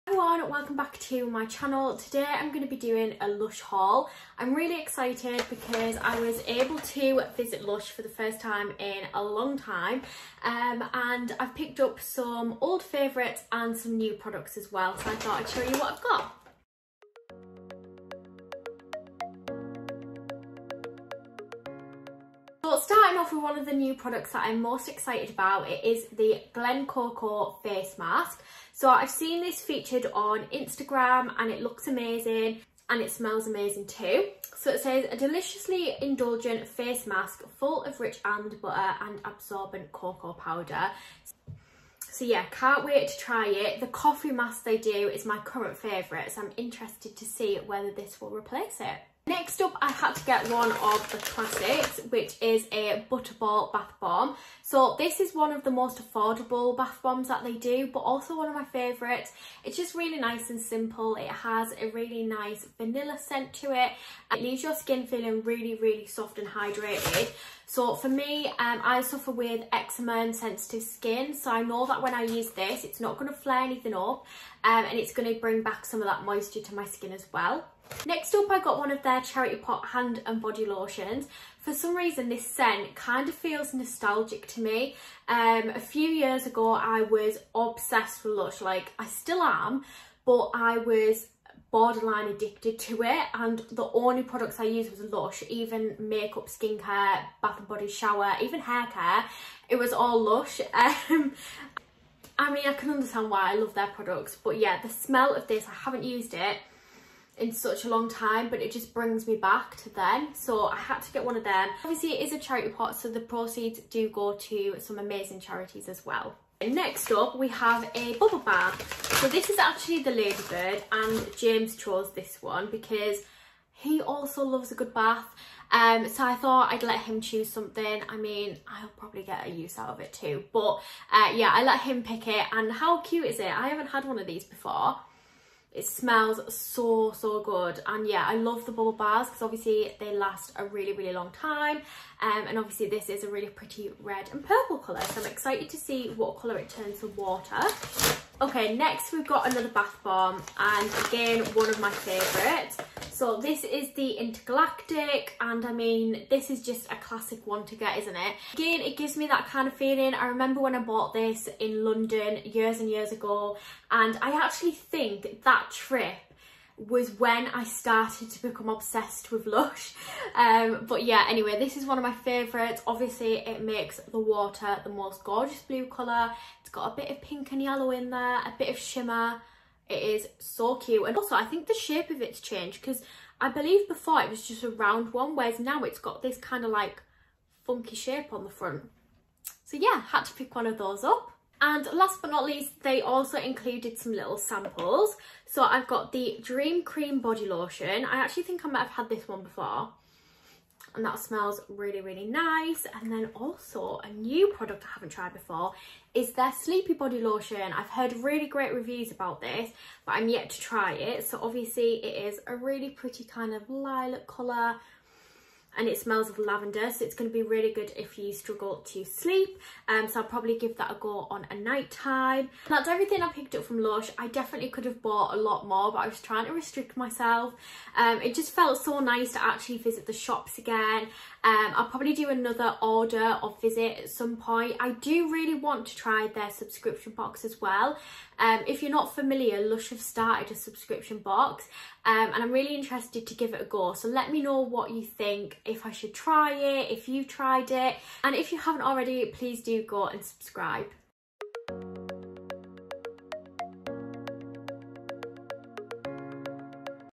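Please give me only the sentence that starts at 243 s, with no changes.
So let me know what you think, if I should try it, if you've tried it.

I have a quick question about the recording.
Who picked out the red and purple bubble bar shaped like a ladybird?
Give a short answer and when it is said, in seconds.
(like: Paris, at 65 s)
James, at 121 s.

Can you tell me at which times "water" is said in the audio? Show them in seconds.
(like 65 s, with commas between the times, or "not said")
147 s, 174 s.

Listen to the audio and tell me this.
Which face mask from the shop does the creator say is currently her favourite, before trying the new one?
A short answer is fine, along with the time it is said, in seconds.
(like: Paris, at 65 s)
coffee mask, at 43 s.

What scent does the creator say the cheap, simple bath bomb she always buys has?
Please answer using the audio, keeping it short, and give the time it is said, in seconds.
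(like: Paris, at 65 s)
vanilla, at 62 s.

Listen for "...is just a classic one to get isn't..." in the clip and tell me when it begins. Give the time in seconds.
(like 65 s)
156 s.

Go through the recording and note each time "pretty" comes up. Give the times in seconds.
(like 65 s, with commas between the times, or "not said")
143 s, 212 s.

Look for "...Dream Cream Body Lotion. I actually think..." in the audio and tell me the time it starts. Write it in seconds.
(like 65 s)
196 s.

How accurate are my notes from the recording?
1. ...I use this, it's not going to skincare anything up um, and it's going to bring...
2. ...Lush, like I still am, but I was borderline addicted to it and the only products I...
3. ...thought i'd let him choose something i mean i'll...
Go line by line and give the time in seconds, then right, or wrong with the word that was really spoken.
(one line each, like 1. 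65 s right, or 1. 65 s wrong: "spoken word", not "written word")
1. 72 s wrong: "flare", not "skincare"
2. 88 s right
3. 126 s right.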